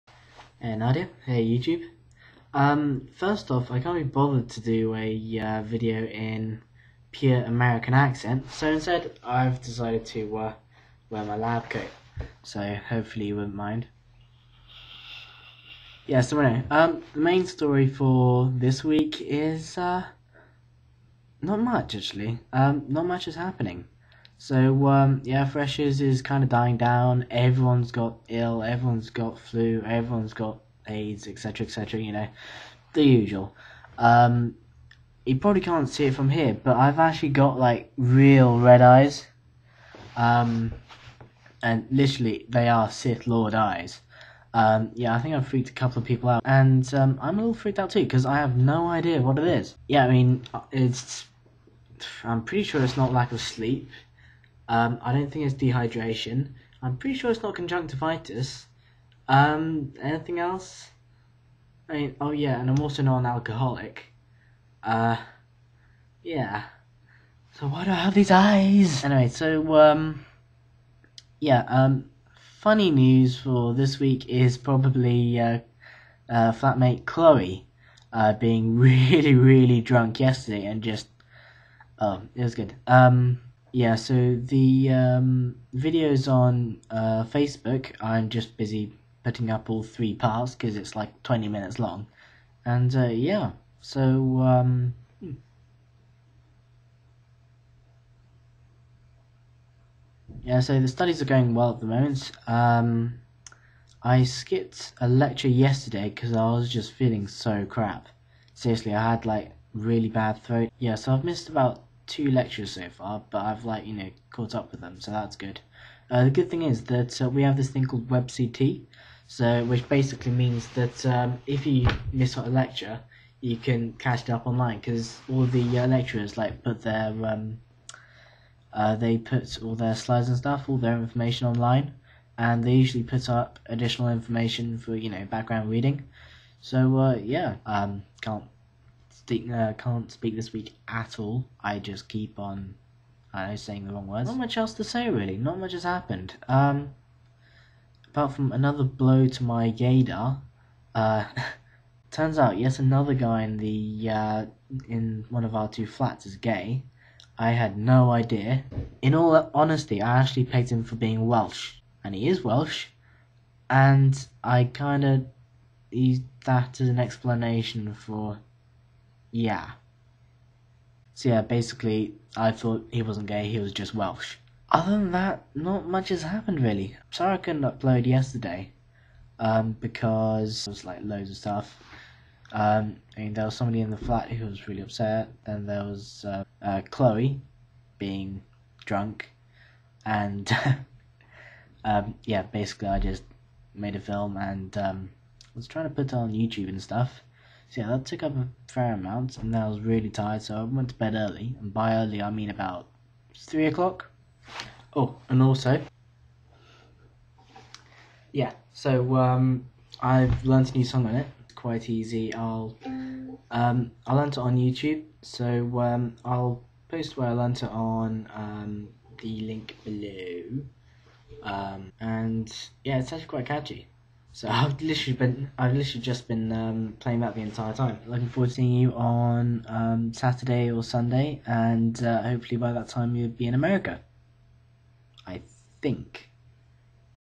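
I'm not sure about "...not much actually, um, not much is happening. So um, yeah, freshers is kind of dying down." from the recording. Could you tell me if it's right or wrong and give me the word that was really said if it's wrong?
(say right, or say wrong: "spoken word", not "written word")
right.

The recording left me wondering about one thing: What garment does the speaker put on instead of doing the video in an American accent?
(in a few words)
lab coat.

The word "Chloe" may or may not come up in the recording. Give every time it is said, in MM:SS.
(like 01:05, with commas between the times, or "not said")
01:17, 03:06.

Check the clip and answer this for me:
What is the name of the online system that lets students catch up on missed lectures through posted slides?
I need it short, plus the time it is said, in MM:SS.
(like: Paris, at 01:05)
WebCT, at 01:58.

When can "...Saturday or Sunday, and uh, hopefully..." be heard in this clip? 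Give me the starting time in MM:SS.
03:50.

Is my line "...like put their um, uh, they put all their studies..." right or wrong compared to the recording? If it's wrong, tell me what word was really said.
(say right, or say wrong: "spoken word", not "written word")
wrong: "slides", not "studies".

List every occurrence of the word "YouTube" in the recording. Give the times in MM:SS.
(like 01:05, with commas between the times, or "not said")
00:01, 03:16, 03:34.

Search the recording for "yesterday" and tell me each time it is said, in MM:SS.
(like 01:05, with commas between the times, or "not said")
01:20, 01:45, 02:58.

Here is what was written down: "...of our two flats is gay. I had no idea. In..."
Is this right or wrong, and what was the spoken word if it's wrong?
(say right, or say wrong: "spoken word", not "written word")
right.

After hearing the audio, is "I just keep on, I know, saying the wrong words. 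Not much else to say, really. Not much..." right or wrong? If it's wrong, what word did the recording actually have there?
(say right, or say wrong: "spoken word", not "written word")
right.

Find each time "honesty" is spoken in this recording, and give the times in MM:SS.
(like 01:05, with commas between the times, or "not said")
02:39.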